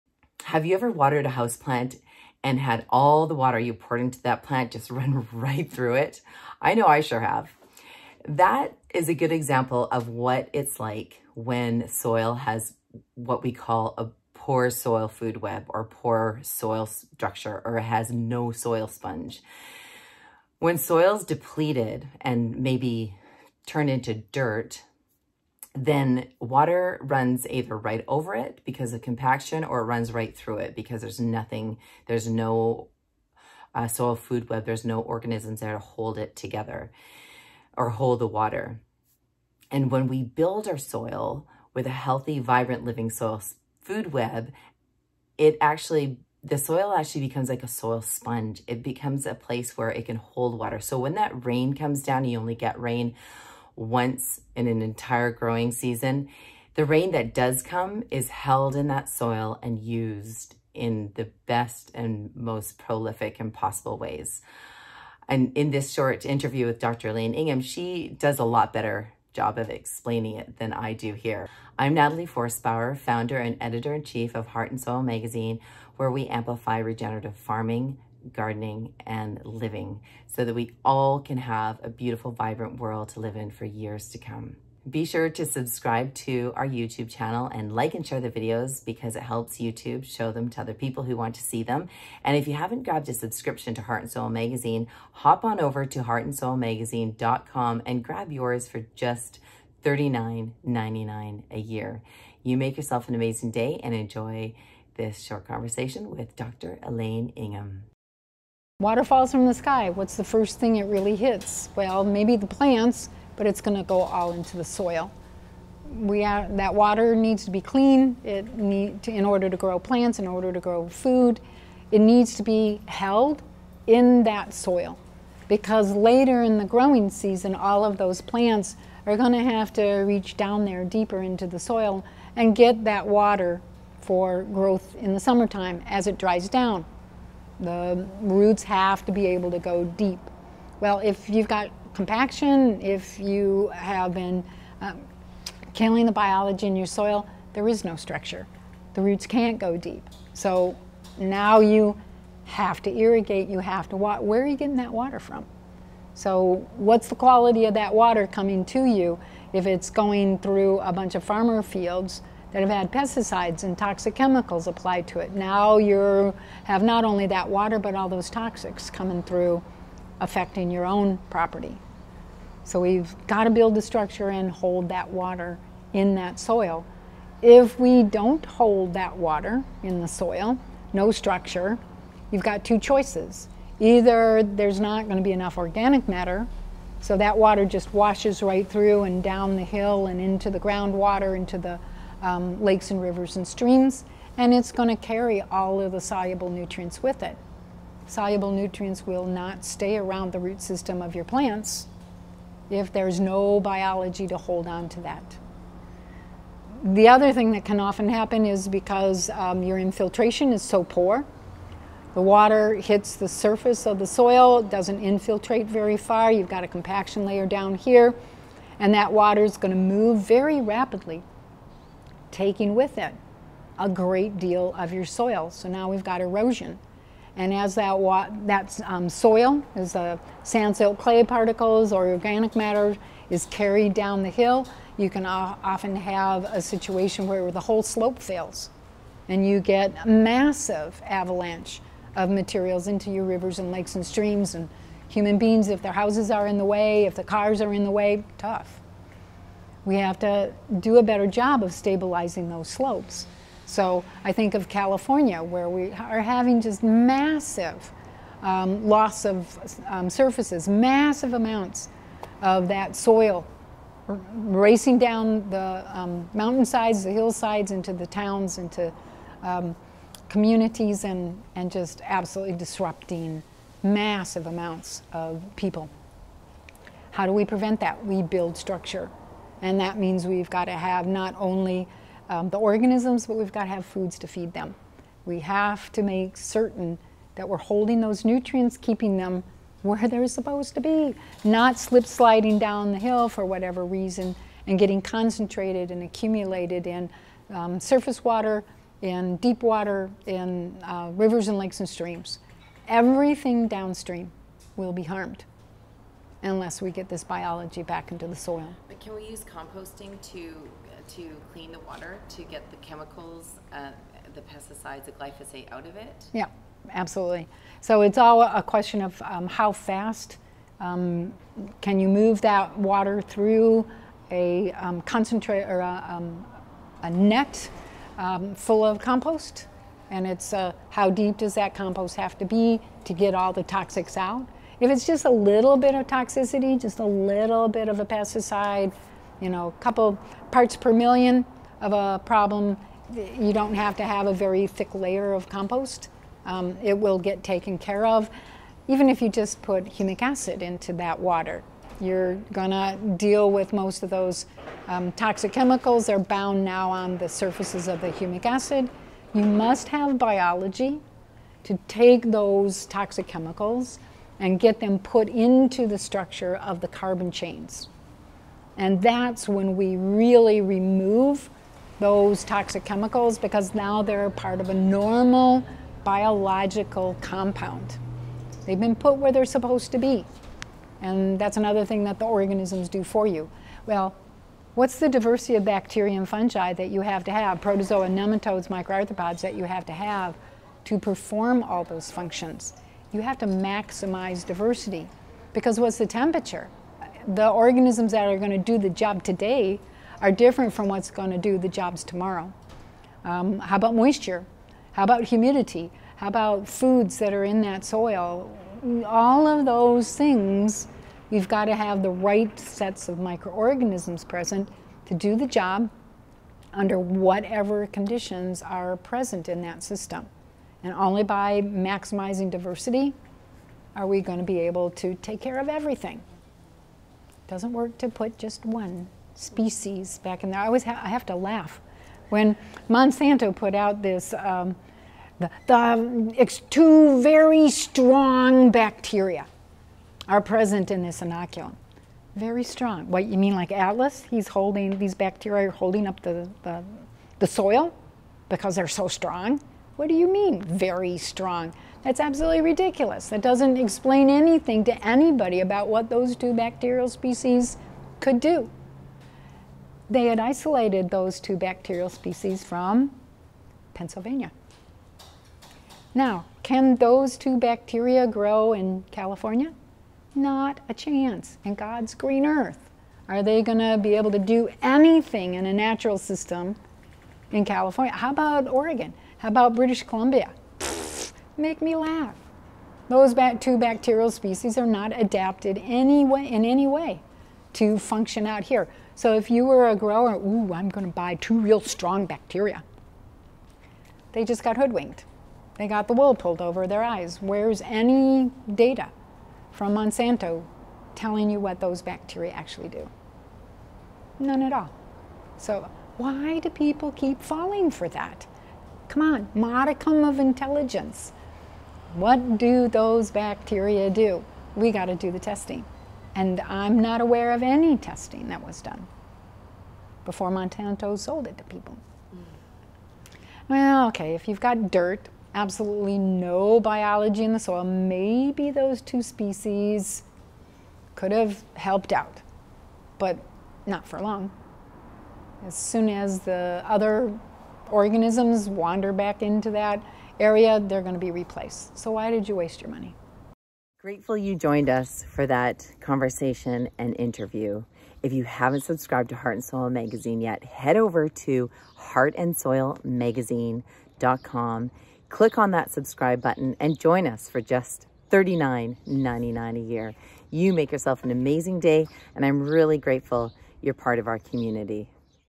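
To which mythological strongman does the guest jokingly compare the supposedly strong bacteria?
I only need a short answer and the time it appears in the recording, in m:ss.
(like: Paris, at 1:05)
Atlas, at 7:23.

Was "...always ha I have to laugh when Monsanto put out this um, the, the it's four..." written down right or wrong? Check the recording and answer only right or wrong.
wrong.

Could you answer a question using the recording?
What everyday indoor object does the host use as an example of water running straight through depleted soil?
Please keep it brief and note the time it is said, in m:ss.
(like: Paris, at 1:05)
house plant, at 0:01.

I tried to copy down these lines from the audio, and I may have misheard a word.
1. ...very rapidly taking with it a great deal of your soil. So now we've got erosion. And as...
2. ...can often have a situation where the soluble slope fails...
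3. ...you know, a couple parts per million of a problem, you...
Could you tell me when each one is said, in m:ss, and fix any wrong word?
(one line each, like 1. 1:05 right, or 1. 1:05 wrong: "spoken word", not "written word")
1. 3:40 right
2. 3:55 wrong: "whole", not "soluble"
3. 5:39 right.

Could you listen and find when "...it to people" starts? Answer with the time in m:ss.
8:41.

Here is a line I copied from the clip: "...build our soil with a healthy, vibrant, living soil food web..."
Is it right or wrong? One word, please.
right.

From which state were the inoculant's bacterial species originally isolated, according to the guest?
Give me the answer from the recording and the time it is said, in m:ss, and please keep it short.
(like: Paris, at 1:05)
Pennsylvania, at 7:43.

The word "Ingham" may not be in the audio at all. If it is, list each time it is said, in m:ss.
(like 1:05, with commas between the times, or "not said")
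1:07, 1:47.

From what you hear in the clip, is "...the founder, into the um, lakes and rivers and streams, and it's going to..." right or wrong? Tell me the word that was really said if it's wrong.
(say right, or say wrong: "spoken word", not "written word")
wrong: "groundwater", not "founder".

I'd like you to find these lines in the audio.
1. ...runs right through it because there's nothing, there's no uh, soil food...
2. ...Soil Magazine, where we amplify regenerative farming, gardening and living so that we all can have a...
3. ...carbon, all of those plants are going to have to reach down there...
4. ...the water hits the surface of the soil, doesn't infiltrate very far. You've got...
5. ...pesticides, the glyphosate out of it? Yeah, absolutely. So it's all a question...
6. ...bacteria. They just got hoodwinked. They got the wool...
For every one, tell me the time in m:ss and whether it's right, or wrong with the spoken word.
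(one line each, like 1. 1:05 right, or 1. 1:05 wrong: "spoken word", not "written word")
1. 0:29 right
2. 1:14 right
3. 2:07 wrong: "season", not "carbon"
4. 3:32 right
5. 5:14 right
6. 8:12 right.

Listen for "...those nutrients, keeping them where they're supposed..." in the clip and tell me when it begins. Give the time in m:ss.
4:48.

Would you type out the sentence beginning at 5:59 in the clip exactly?
You must have biology to take those toxic chemicals and get them put into the structure of the carbon chains.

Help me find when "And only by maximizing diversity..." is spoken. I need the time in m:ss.
7:00.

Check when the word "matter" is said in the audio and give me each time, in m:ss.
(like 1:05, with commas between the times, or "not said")
3:06, 3:52.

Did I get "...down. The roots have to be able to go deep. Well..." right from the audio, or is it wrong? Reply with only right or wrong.
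right.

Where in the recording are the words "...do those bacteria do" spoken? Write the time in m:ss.
8:32.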